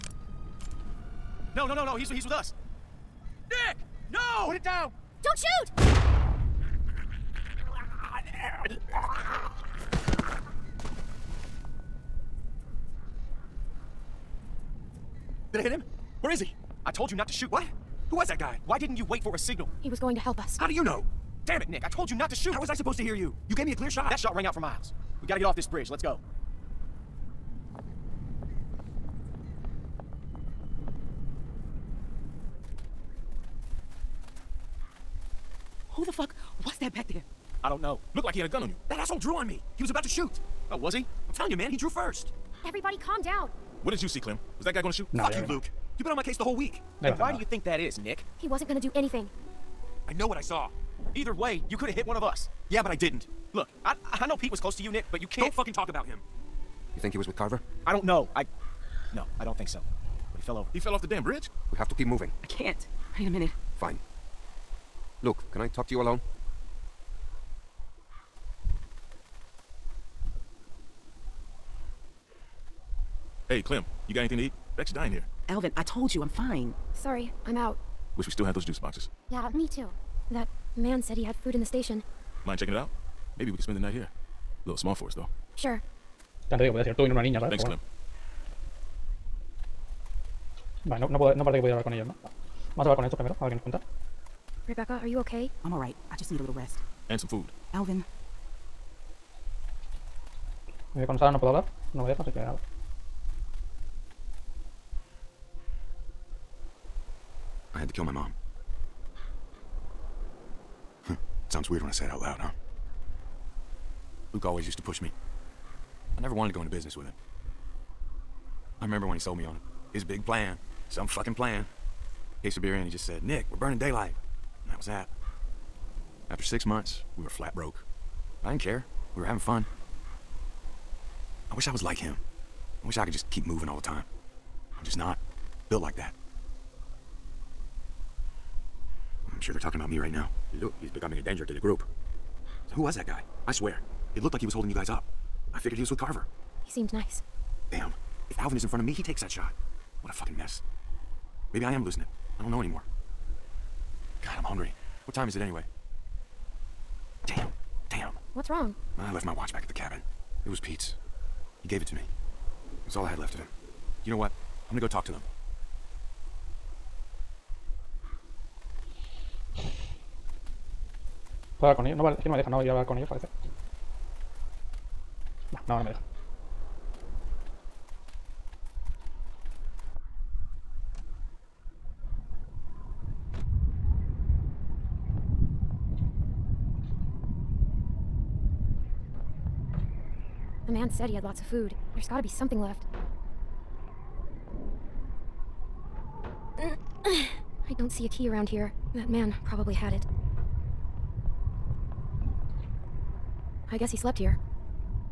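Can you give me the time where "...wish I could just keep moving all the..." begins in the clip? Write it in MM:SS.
02:12.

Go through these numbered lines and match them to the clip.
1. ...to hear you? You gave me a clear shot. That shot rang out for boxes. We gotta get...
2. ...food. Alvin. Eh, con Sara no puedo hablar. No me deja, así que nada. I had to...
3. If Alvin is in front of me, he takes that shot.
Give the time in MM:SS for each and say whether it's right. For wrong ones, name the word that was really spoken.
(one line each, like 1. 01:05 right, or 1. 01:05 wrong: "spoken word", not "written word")
1. 00:22 wrong: "miles", not "boxes"
2. 01:37 right
3. 02:28 right.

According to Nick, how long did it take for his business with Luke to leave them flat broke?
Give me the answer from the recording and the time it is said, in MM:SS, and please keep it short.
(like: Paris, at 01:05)
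6 months, at 02:06.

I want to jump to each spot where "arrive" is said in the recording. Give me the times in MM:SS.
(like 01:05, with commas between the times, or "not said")
not said.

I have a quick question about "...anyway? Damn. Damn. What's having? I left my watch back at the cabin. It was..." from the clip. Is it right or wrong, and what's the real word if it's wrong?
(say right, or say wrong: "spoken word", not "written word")
wrong: "wrong", not "having".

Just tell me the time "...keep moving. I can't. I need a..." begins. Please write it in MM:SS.
01:01.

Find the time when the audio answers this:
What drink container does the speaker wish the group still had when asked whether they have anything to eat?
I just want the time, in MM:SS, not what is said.
01:18.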